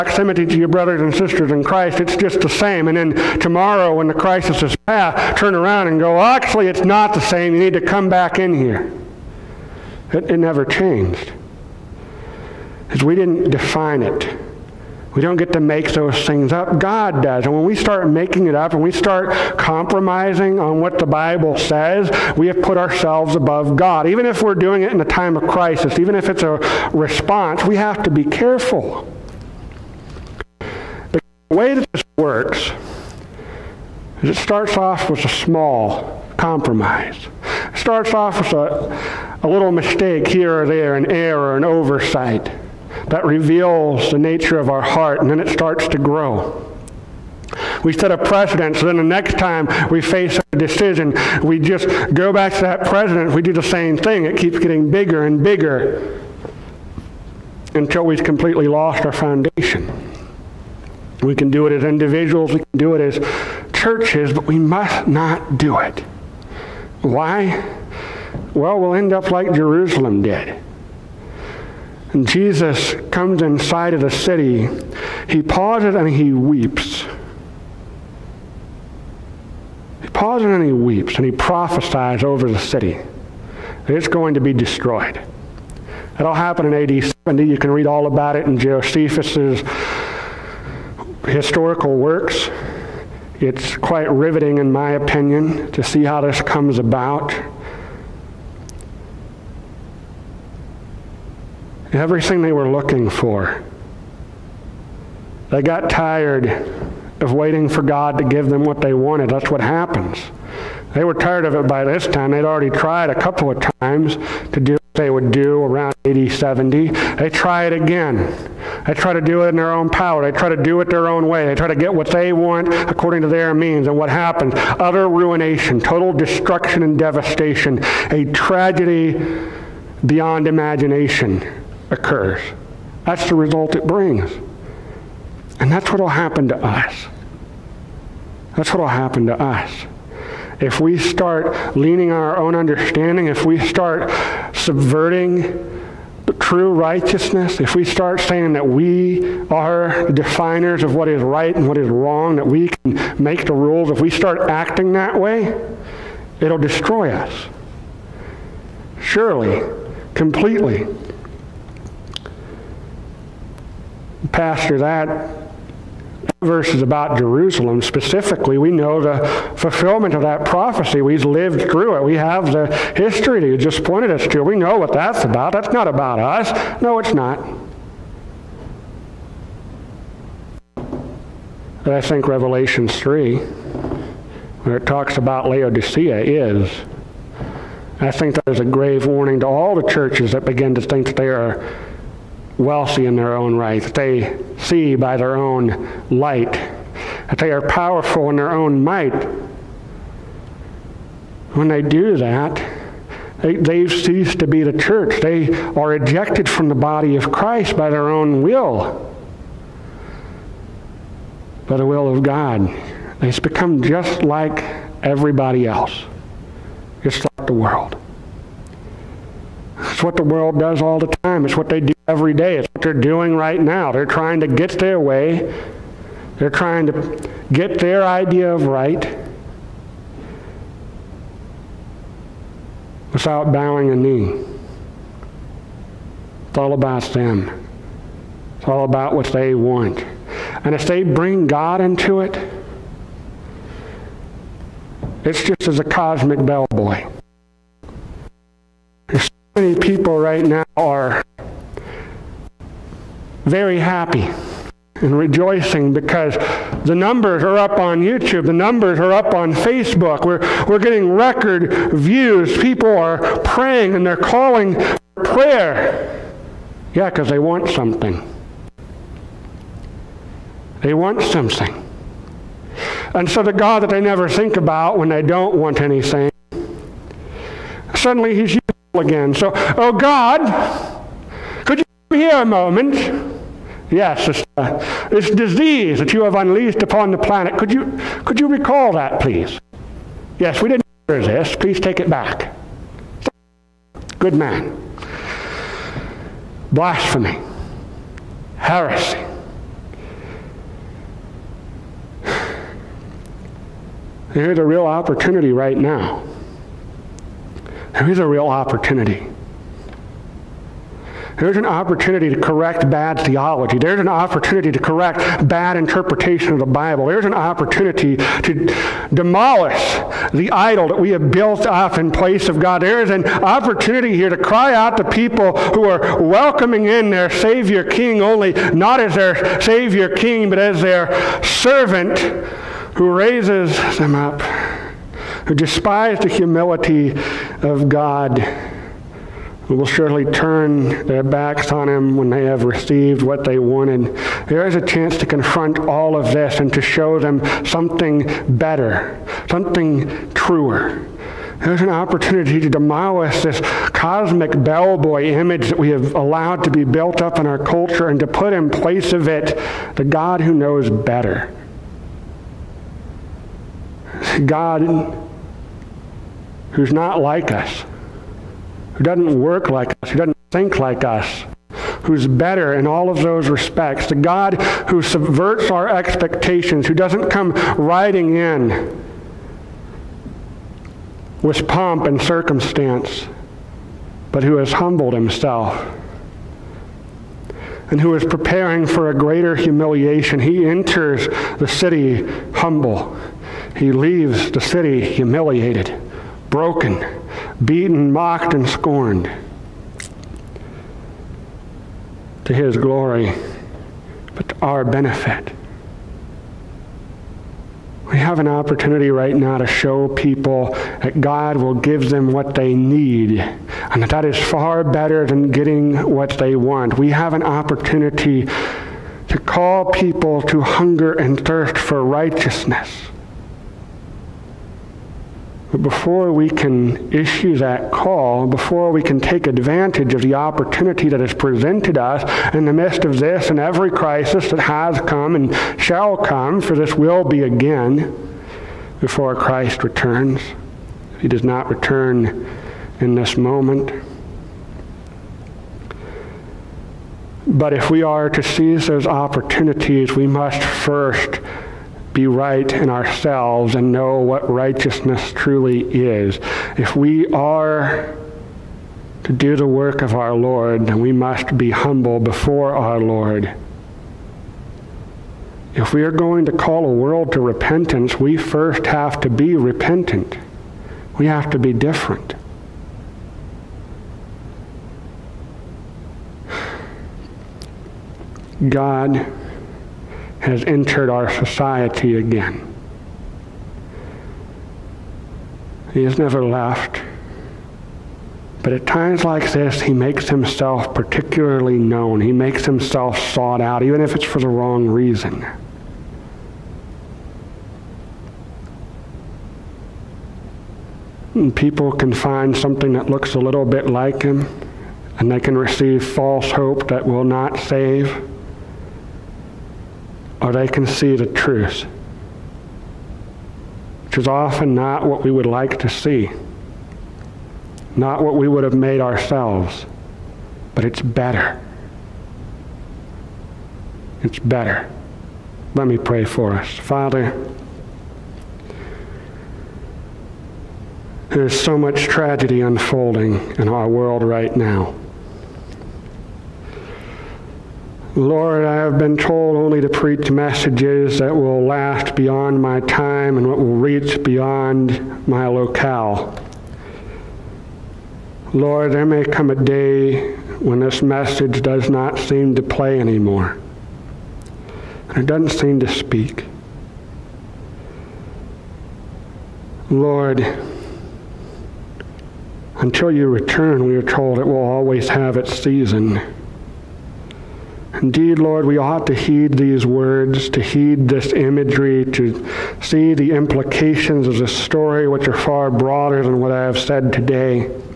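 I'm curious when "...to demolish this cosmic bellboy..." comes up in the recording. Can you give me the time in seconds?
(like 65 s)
352 s.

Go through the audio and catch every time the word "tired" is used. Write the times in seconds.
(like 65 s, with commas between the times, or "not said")
105 s, 111 s.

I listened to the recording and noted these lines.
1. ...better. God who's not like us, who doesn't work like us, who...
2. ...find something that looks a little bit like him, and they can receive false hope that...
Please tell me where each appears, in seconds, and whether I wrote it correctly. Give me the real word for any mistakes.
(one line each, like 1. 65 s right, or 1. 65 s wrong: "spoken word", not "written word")
1. 360 s right
2. 502 s right.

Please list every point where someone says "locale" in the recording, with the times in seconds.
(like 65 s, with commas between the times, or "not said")
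545 s.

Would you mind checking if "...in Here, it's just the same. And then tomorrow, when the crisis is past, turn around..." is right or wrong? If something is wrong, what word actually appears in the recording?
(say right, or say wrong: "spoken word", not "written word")
wrong: "Christ", not "Here".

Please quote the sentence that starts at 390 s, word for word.
He enters the city humble, he leaves the city humiliated broken, beaten, mocked, and scorned.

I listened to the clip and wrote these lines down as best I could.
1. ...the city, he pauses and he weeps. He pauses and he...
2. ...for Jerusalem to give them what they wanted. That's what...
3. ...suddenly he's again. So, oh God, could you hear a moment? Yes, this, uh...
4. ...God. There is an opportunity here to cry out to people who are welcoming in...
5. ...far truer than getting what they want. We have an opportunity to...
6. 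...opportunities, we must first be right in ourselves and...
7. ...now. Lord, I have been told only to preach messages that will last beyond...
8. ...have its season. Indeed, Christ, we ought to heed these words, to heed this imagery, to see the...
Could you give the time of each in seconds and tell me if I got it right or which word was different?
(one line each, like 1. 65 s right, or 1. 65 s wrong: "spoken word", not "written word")
1. 73 s right
2. 107 s wrong: "God", not "Jerusalem"
3. 277 s right
4. 322 s right
5. 414 s wrong: "better", not "truer"
6. 449 s right
7. 534 s right
8. 565 s wrong: "Lord", not "Christ".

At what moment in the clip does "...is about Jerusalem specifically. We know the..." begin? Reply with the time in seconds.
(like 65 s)
166 s.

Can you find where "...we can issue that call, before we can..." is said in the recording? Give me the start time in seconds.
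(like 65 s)
426 s.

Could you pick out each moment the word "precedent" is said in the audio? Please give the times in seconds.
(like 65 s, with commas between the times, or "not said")
48 s, 52 s.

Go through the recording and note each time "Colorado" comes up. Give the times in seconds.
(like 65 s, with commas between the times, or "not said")
not said.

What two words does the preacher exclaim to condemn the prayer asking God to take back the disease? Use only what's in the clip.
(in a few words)
Blasphemy, heresy.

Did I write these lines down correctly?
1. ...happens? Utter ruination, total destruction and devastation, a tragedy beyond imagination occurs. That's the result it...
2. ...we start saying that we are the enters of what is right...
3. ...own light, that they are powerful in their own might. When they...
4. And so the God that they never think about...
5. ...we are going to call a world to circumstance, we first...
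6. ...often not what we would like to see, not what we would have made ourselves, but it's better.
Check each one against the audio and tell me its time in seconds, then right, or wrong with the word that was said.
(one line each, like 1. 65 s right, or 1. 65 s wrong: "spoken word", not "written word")
1. 124 s right
2. 147 s wrong: "definers", not "enters"
3. 195 s right
4. 273 s right
5. 465 s wrong: "repentance", not "circumstance"
6. 514 s right.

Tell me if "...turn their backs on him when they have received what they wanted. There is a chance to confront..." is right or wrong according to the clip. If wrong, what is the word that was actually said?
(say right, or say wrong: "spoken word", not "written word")
right.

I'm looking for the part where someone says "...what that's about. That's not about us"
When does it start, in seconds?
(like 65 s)
174 s.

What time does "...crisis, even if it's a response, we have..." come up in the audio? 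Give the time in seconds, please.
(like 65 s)
25 s.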